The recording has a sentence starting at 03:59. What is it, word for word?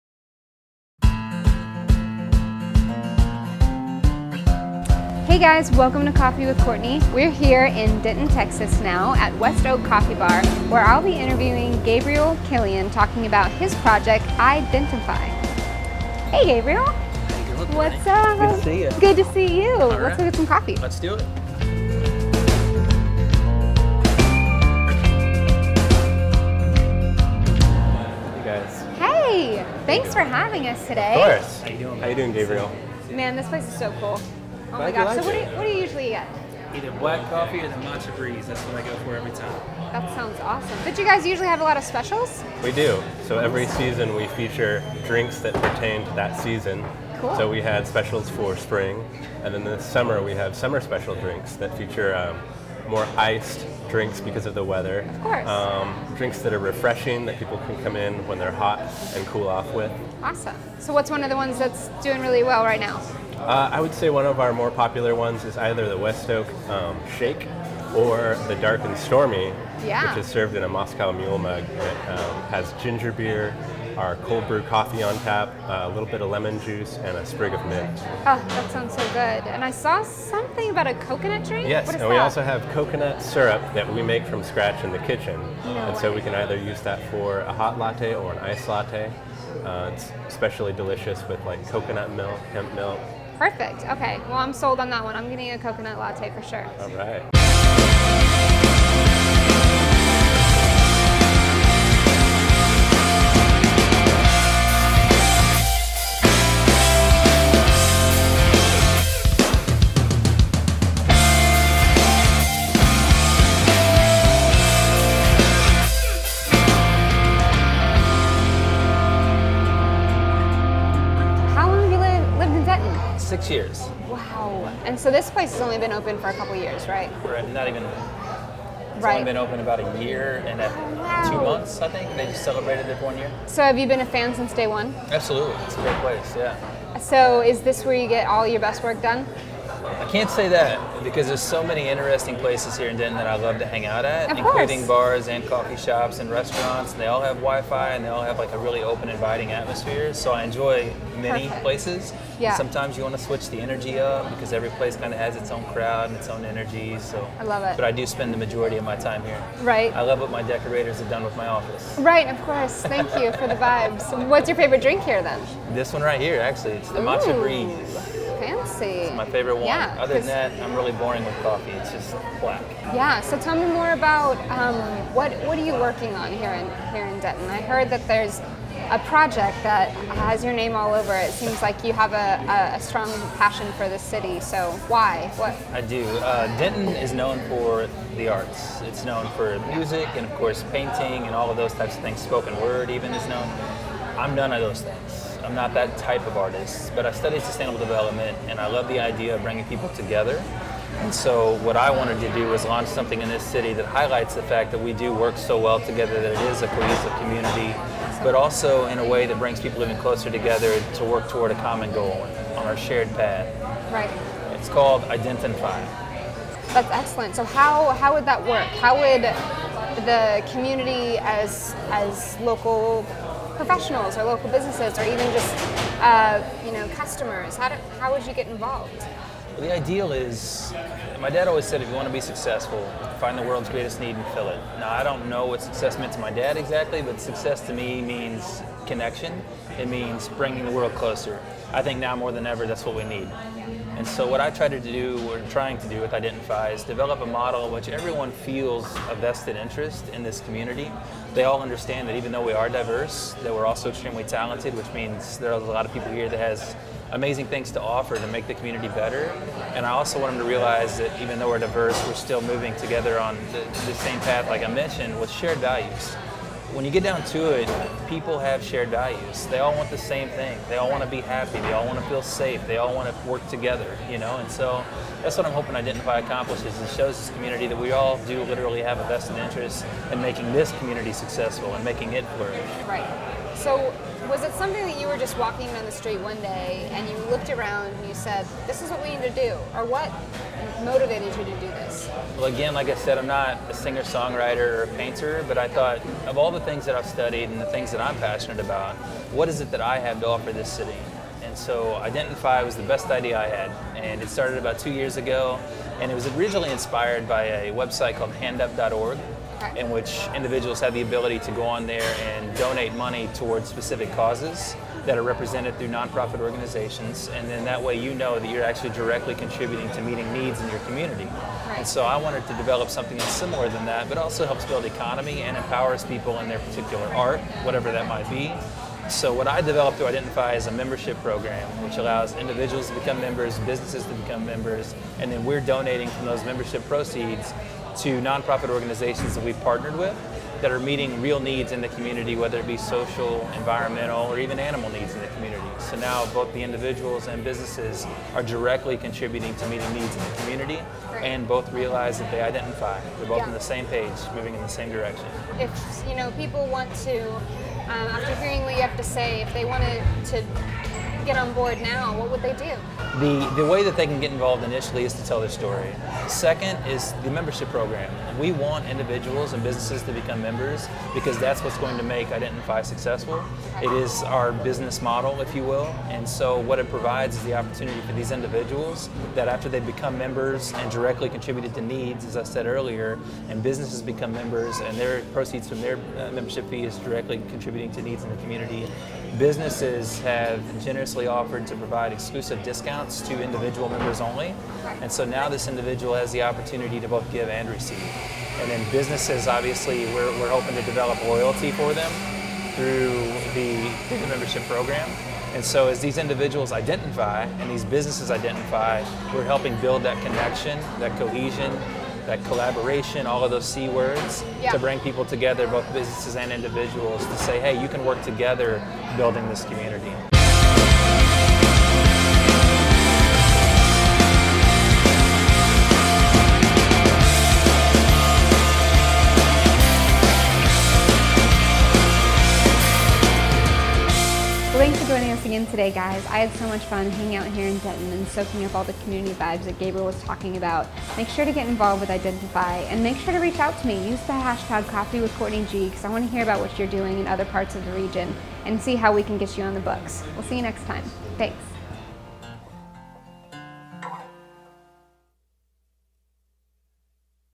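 It means bringing the world closer.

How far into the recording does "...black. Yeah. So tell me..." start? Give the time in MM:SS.
02:52.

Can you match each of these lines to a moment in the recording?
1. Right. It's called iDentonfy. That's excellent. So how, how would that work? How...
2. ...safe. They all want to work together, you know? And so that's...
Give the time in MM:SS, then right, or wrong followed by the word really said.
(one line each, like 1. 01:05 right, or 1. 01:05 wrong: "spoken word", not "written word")
1. 03:33 right
2. 04:32 right.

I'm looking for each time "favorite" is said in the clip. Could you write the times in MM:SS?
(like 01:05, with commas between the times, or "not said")
02:44, 02:49.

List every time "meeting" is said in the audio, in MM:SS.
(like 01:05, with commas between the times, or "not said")
05:20, 05:40, 05:49.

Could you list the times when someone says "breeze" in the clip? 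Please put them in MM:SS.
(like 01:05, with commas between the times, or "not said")
00:38, 02:47.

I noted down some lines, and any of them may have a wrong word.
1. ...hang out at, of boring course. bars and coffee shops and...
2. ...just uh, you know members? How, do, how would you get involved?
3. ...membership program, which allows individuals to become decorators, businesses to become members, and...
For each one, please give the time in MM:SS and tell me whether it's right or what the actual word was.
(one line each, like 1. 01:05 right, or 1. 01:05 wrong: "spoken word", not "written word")
1. 02:23 wrong: "including", not "boring"
2. 03:45 wrong: "customers", not "members"
3. 05:30 wrong: "members", not "decorators".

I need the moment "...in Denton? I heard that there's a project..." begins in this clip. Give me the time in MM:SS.
02:57.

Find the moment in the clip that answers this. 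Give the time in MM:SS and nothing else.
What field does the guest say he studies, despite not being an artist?
03:17.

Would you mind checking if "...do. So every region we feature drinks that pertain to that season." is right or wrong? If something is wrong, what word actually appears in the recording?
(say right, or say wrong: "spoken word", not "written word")
wrong: "season", not "region".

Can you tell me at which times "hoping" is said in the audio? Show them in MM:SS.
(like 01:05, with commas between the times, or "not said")
04:35, 06:40.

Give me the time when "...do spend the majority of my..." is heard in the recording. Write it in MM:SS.
02:37.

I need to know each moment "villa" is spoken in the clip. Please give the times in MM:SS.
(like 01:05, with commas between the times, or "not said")
not said.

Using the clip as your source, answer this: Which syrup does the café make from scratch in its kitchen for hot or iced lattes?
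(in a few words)
Coconut syrup.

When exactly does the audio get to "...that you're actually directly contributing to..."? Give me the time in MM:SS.
05:18.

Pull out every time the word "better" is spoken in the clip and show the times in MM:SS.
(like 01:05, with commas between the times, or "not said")
04:18.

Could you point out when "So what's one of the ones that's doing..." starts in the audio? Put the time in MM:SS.
01:00.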